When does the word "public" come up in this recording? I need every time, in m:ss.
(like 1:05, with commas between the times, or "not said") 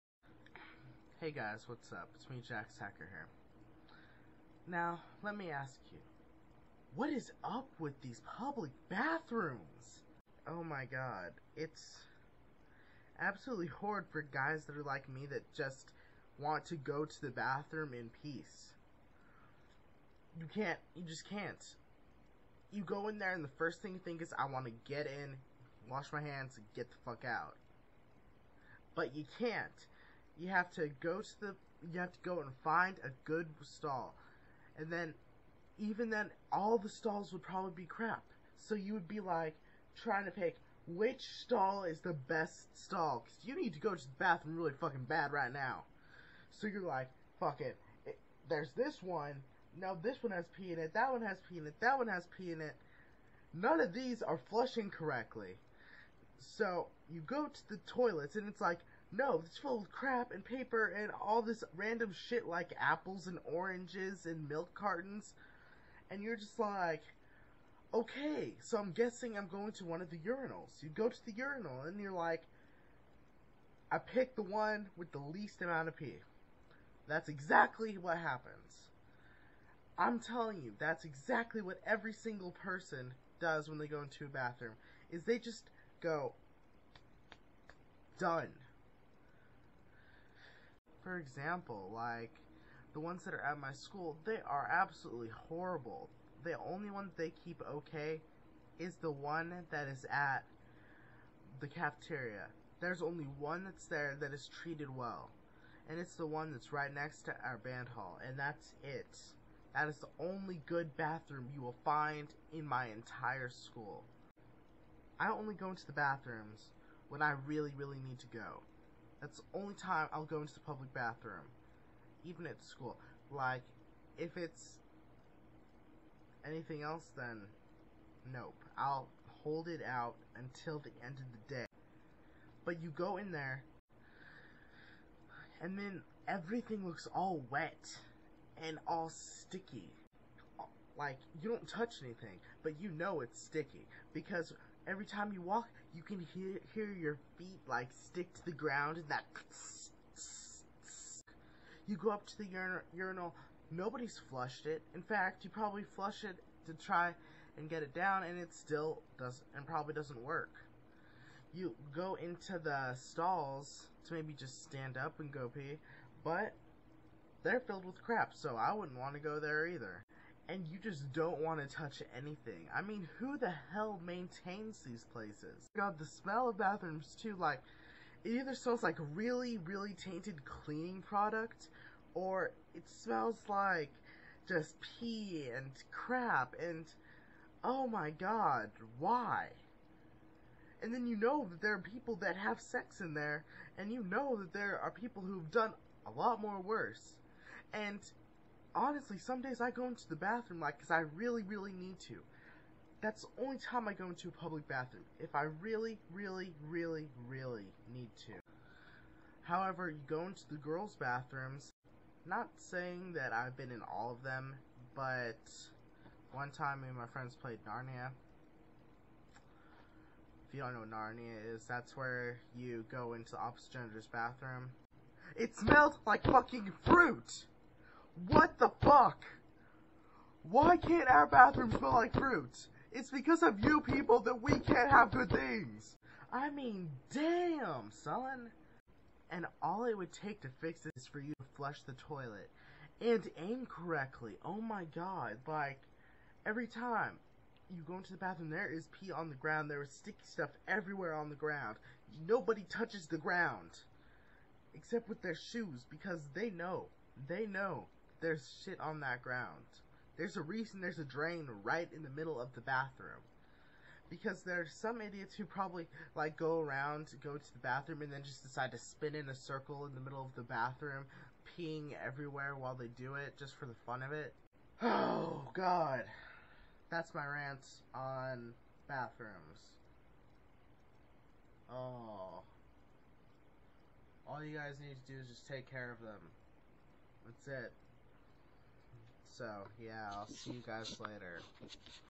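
0:08, 2:00, 3:24.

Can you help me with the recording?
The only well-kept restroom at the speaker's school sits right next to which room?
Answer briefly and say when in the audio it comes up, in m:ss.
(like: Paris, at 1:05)
band hall, at 1:47.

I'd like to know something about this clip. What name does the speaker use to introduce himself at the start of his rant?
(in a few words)
Jax Hacker.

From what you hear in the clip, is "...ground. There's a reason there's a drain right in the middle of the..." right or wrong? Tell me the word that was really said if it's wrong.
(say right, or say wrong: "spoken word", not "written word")
right.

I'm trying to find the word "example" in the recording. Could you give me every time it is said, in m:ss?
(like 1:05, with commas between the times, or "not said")
1:31.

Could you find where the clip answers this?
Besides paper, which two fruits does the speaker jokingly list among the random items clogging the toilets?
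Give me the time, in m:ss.
1:02.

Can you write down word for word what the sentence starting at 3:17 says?
And honestly, some days I go into the bathroom like because I really, really need to.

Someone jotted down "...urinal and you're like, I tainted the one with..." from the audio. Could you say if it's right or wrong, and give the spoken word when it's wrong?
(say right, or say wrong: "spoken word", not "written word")
wrong: "picked", not "tainted".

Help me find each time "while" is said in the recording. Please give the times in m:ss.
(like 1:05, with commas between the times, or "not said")
4:32.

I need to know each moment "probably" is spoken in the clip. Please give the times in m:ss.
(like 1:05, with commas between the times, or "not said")
0:37, 2:35, 2:39, 4:25.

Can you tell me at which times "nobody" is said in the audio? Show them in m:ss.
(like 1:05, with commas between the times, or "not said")
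2:33, 4:12.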